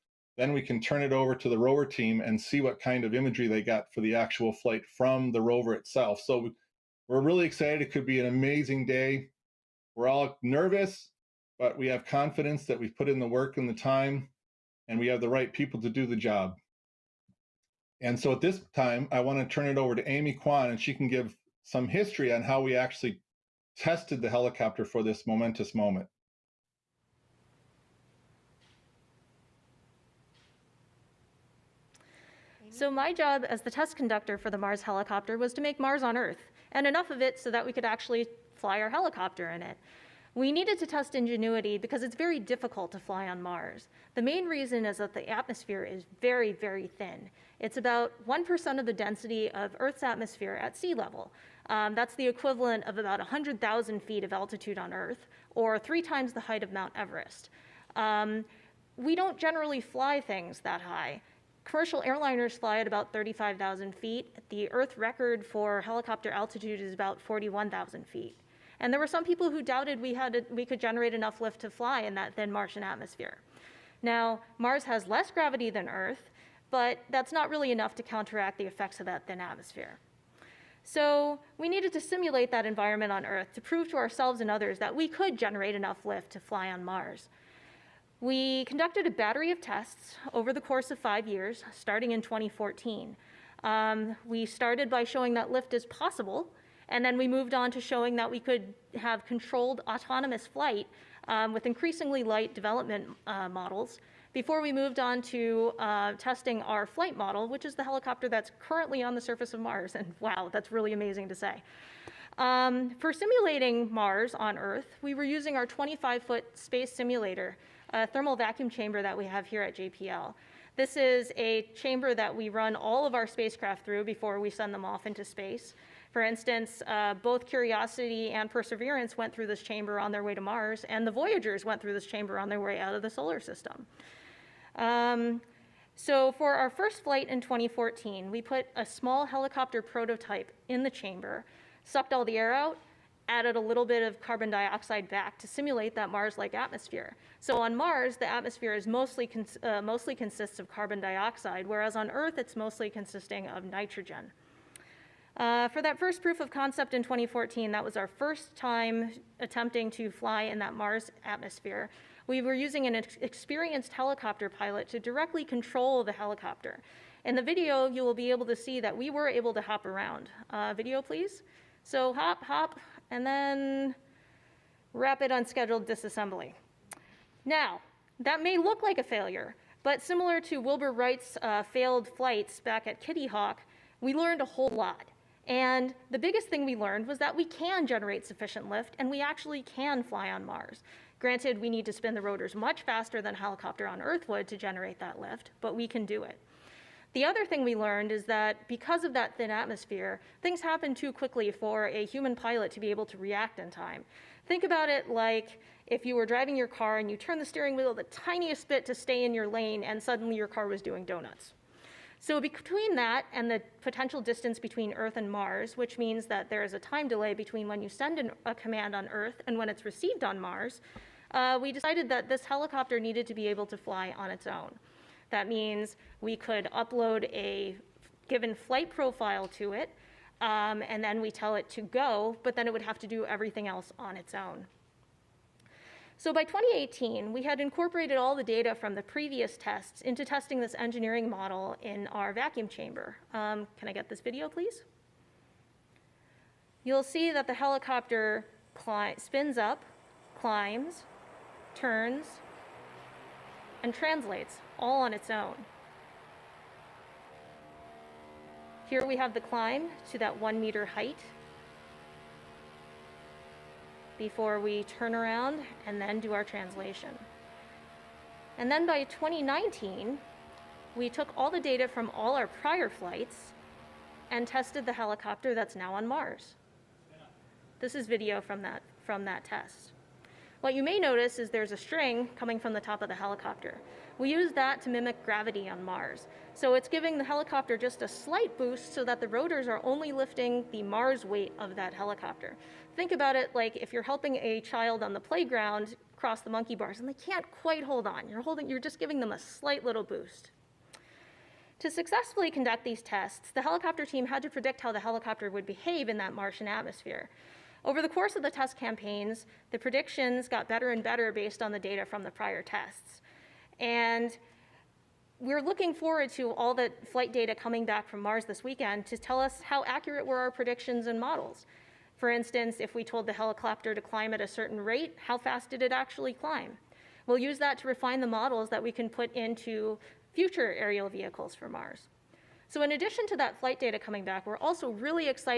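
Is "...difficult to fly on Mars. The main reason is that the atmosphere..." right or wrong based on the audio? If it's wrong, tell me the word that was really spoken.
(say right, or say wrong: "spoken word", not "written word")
right.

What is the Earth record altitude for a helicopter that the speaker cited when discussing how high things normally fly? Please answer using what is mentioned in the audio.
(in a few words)
41,000 feet.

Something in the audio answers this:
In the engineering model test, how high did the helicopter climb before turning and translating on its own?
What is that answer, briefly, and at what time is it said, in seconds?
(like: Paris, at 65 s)
1 meter, at 260 s.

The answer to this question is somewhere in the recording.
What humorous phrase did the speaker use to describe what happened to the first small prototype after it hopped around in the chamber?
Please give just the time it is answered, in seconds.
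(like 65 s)
174 s.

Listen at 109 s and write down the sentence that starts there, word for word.
And wow, that's really amazing to say.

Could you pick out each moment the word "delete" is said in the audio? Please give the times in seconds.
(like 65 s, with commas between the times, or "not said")
not said.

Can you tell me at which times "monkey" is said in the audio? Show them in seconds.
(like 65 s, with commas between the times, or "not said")
296 s.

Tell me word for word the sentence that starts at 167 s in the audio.
In the video, you will be able to see that we were able to hop around.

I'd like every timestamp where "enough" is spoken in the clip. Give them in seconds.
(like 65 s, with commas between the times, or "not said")
36 s, 71 s, 77 s, 85 s.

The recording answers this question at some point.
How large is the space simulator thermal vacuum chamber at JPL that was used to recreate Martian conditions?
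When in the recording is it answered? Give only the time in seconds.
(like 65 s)
115 s.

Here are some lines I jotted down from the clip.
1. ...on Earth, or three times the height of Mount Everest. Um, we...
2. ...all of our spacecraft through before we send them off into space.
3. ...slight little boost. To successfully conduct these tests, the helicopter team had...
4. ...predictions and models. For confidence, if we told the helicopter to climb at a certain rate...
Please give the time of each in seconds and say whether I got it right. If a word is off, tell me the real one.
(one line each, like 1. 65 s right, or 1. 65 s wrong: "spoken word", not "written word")
1. 54 s right
2. 122 s right
3. 299 s right
4. 320 s wrong: "instance", not "confidence".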